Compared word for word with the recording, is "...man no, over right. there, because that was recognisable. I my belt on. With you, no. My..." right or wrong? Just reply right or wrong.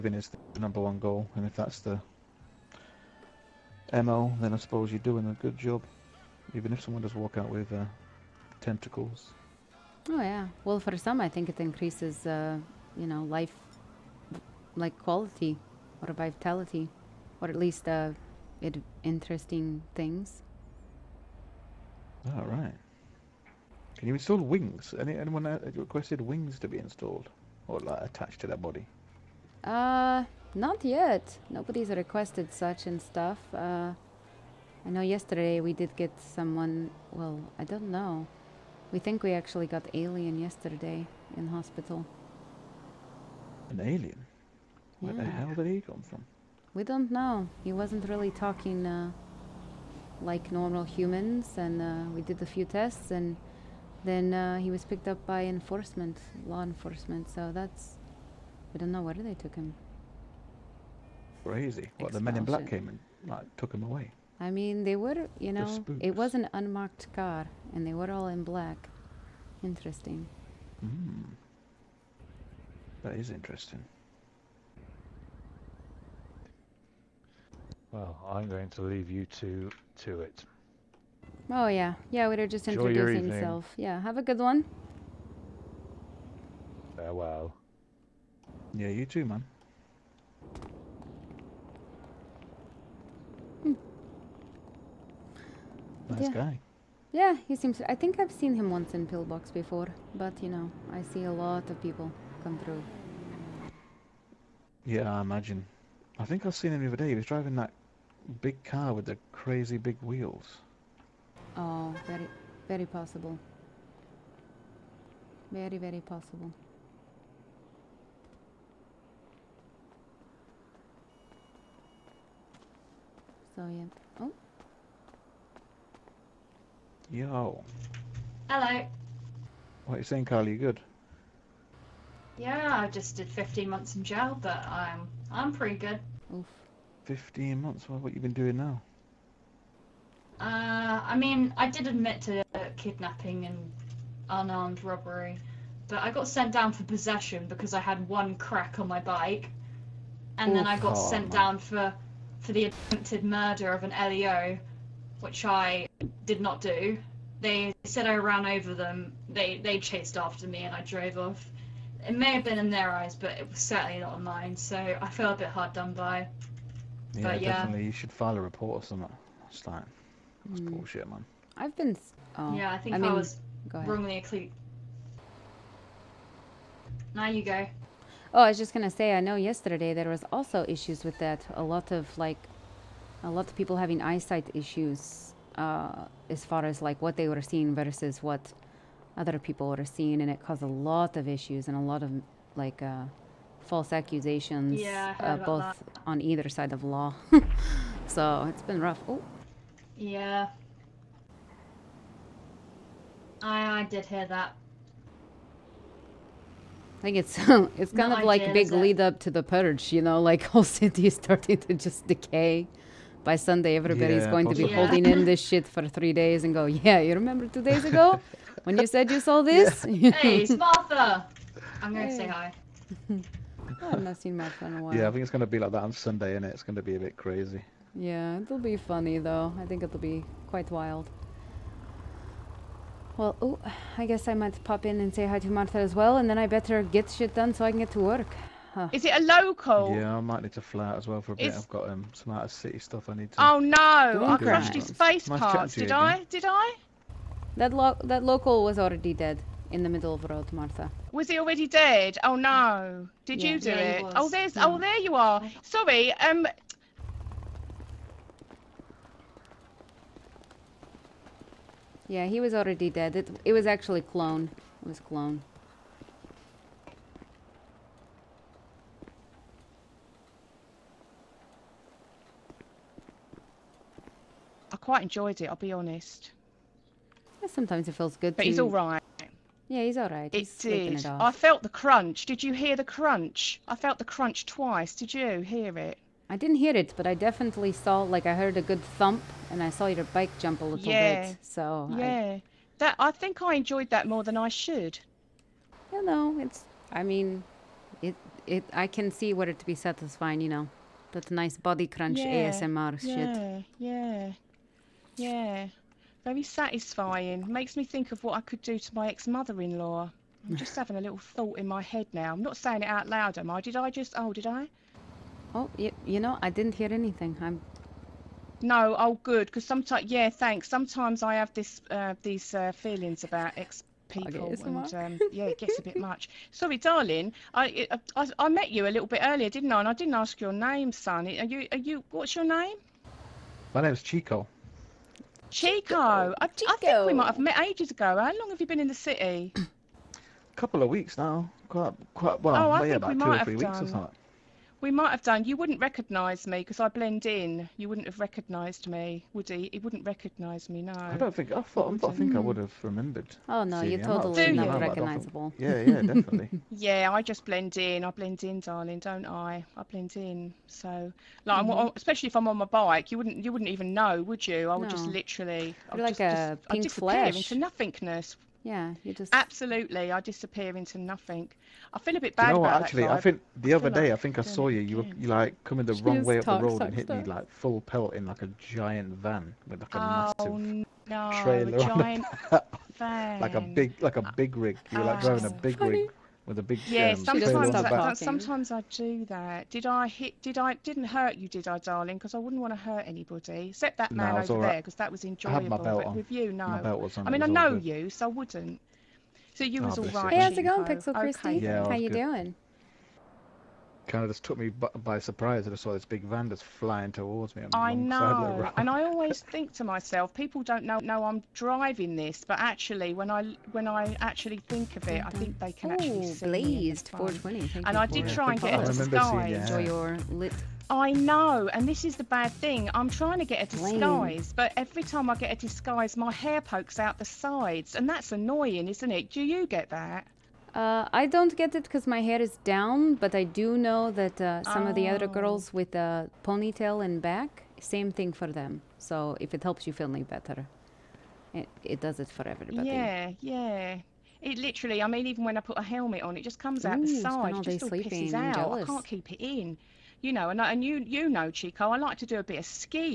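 wrong.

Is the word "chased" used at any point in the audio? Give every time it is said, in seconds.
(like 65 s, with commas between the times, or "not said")
159 s.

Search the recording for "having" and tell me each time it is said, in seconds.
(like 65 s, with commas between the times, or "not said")
183 s, 310 s.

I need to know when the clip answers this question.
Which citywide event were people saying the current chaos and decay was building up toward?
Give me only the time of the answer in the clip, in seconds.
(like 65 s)
209 s.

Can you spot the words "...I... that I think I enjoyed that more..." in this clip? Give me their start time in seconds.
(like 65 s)
292 s.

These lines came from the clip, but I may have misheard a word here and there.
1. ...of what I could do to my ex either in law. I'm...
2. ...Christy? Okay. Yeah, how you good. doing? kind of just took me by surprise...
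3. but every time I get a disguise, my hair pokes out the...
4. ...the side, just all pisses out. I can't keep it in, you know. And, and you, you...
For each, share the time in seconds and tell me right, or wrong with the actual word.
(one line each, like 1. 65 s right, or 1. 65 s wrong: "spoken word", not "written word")
1. 308 s wrong: "mother", not "either"
2. 401 s right
3. 424 s right
4. 447 s right.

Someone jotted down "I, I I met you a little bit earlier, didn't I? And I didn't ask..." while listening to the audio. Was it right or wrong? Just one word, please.
right.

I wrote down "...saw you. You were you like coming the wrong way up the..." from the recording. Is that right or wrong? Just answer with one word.
right.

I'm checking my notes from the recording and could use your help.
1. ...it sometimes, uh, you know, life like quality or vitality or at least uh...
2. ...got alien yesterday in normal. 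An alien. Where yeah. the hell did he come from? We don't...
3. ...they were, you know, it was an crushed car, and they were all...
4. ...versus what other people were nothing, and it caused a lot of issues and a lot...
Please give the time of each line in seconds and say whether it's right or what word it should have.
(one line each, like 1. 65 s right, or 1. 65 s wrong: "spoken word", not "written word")
1. 11 s wrong: "increases", not "sometimes"
2. 39 s wrong: "hospital", not "normal"
3. 64 s wrong: "unmarked", not "crushed"
4. 187 s wrong: "seeing", not "nothing".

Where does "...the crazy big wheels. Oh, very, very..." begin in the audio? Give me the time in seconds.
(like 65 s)
109 s.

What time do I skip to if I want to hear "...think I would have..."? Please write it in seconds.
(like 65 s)
352 s.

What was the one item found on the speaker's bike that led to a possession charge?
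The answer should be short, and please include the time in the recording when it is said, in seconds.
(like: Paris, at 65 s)
One crack, at 148 s.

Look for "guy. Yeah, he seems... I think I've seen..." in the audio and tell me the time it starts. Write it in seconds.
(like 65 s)
96 s.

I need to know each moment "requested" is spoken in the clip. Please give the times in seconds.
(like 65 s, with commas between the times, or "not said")
25 s, 31 s.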